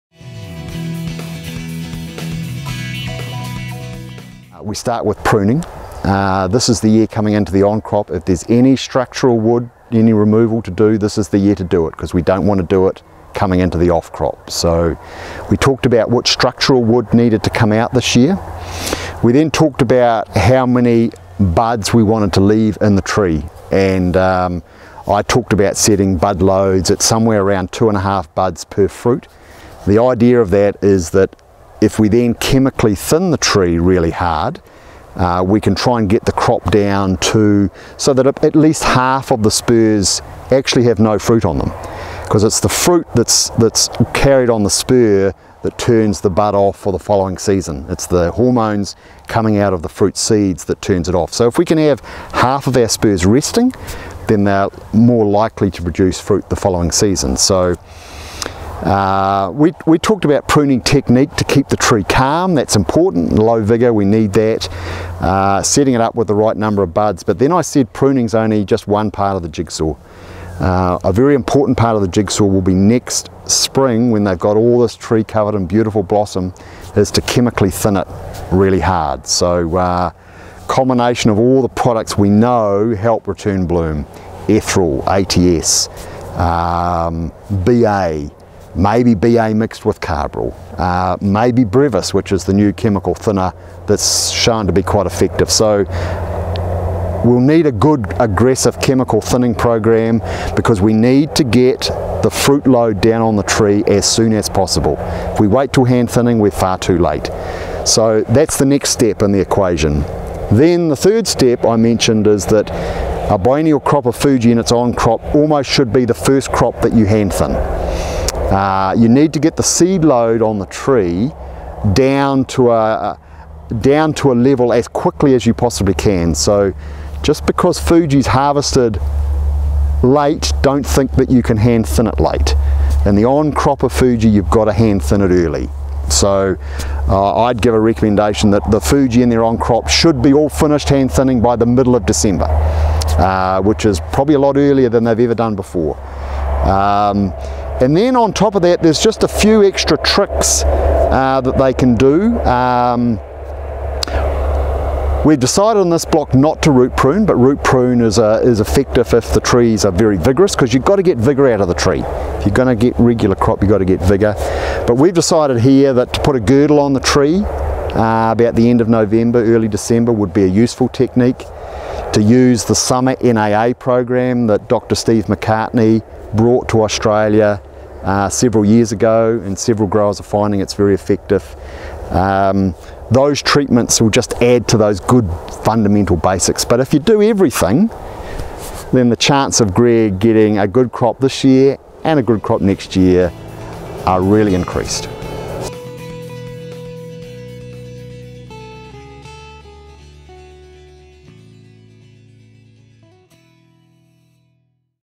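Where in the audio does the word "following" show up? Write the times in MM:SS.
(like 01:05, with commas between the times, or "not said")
00:46, 00:56.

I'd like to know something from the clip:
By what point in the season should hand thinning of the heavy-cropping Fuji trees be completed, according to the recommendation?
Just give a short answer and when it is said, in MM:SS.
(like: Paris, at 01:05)
Middle of December, at 02:21.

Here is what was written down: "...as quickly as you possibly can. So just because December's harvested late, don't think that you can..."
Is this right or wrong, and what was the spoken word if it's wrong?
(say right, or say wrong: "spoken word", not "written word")
wrong: "Fuji", not "December".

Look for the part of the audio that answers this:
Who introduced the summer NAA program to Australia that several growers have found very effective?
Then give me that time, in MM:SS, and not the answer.
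02:54.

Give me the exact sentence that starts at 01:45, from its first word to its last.
If we wait till hand thinning, we're far too late.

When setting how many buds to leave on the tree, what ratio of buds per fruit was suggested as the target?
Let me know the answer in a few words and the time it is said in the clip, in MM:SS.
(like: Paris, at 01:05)
2.5 buds per fruit, at 00:27.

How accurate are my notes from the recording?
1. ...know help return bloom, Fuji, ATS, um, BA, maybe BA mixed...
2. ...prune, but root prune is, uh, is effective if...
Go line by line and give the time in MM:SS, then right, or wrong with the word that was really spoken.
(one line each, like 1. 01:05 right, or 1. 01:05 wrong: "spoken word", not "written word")
1. 01:22 wrong: "Ethrel", not "Fuji"
2. 02:36 right.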